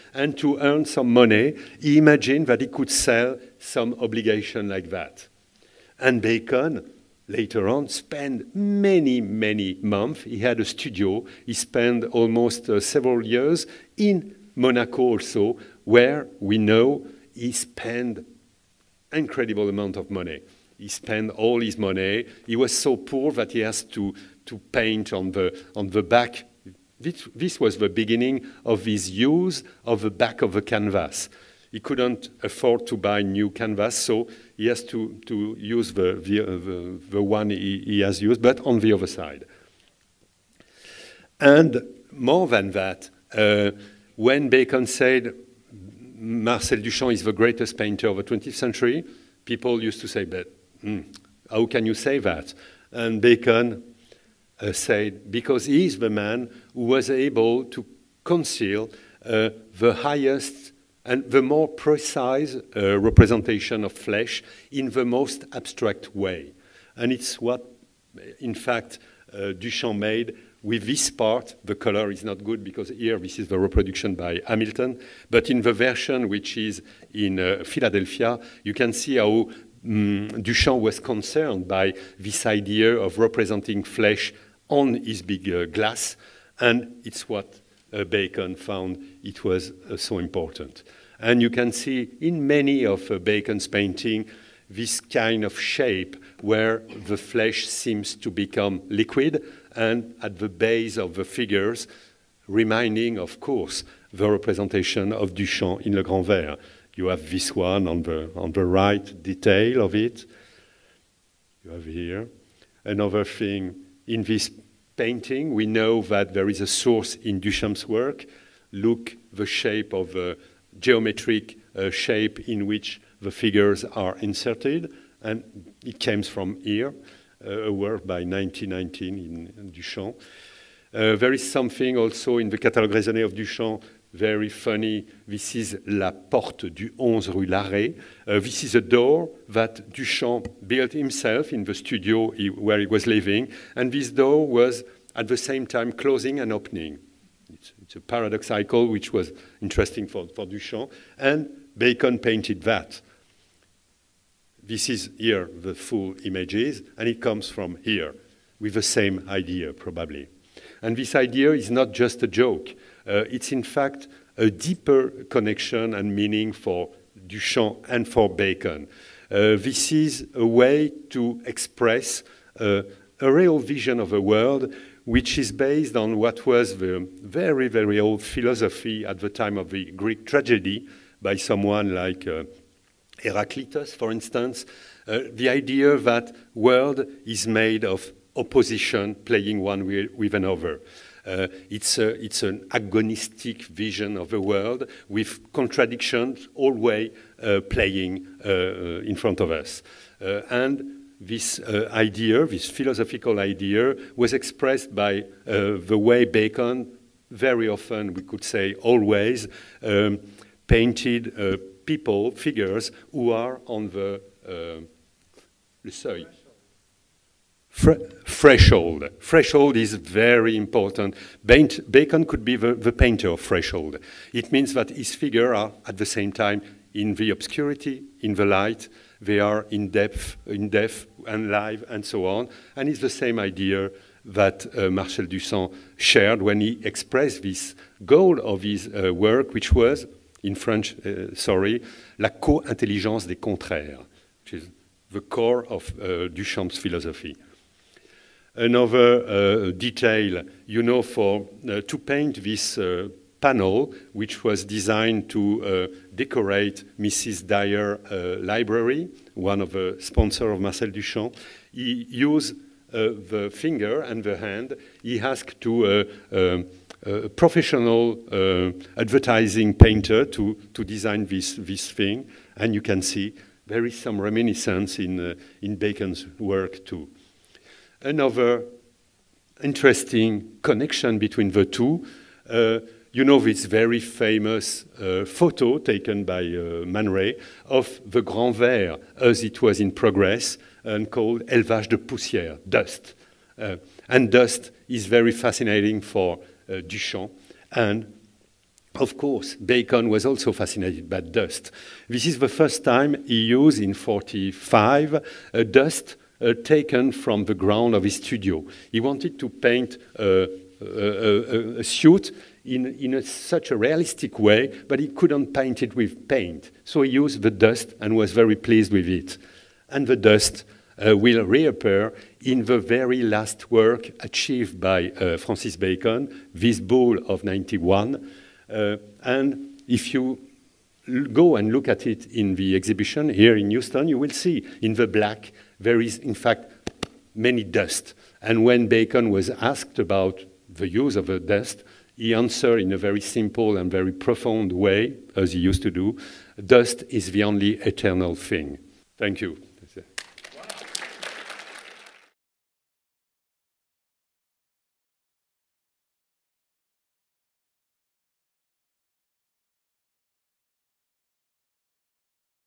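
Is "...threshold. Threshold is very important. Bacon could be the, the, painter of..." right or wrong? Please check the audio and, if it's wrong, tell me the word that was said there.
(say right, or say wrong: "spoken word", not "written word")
right.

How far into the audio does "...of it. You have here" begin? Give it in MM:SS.
01:49.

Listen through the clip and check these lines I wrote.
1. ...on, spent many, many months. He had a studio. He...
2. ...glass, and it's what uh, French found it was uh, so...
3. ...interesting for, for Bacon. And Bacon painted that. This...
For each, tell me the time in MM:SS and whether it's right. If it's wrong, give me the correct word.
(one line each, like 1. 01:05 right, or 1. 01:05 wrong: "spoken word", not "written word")
1. 00:07 right
2. 01:25 wrong: "Bacon", not "French"
3. 02:29 wrong: "Duchamp", not "Bacon".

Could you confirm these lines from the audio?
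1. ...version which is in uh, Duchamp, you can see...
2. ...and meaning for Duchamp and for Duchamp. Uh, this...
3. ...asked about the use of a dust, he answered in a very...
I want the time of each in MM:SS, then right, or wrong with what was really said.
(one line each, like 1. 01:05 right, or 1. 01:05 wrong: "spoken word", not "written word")
1. 01:15 wrong: "Philadelphia", not "Duchamp"
2. 02:45 wrong: "Bacon", not "Duchamp"
3. 05:39 right.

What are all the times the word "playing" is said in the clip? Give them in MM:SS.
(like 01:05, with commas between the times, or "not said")
03:09, 03:17.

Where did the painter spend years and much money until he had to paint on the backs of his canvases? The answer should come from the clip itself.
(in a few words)
Monaco.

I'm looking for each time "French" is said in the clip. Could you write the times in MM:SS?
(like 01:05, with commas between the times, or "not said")
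04:00.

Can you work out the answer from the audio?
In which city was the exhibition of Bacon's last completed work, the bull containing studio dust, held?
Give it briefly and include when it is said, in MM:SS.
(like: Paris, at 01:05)
Houston, at 05:33.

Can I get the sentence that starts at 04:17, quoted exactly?
Dreier library, one of the sponsor of Marcel Duchamp, he used the finger and the hand.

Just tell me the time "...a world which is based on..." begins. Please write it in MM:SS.
02:54.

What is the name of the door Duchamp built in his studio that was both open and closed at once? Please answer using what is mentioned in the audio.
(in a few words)
La porte du 11 rue Larrey.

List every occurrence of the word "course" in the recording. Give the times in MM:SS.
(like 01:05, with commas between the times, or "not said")
01:43, 04:59.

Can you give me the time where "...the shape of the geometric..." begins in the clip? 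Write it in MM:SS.
01:59.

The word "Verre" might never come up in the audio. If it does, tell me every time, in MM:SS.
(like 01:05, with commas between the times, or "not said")
01:46, 04:48.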